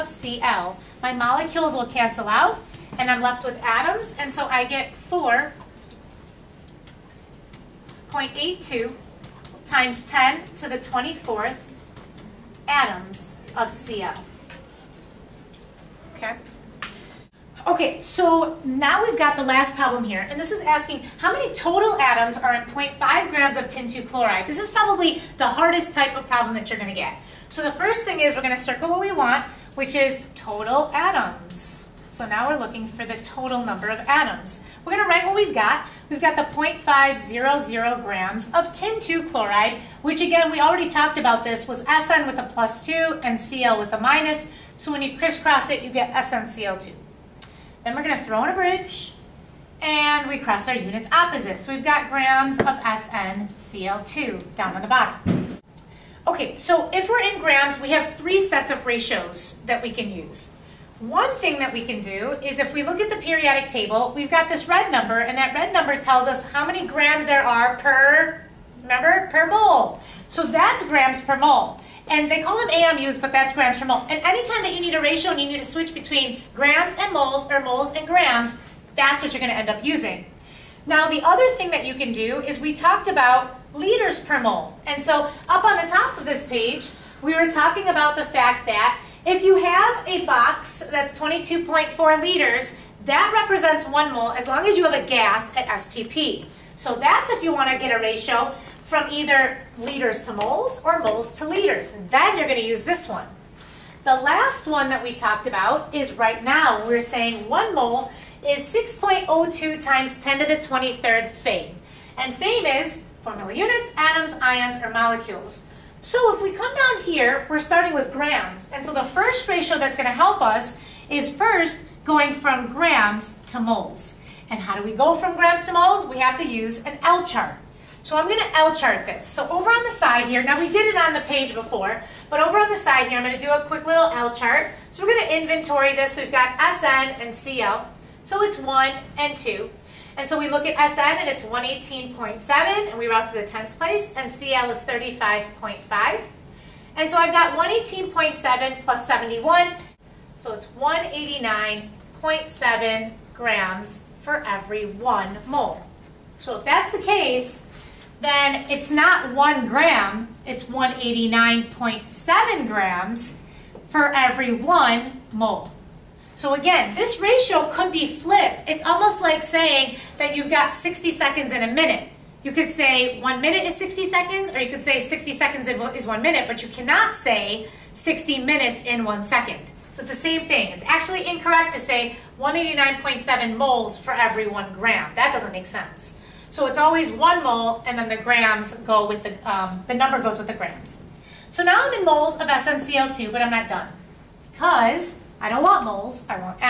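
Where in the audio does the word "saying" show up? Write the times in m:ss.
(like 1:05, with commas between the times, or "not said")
1:47, 2:49.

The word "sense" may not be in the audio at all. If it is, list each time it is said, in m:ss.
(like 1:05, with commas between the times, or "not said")
3:05.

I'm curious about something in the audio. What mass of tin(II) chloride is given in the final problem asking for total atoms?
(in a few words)
0.500 grams.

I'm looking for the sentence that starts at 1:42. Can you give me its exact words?
Then you're going to use this one.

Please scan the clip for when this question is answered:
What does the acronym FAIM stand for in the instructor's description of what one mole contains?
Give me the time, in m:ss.
1:53.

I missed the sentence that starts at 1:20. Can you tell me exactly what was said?
Now, the other thing that you can do is we talked about liters per mole.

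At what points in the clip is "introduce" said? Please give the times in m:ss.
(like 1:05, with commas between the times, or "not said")
not said.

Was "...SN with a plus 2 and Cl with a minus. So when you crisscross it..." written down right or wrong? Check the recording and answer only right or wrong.
right.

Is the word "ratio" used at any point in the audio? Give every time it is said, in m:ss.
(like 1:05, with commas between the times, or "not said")
0:58, 1:15, 1:38, 1:59, 2:47.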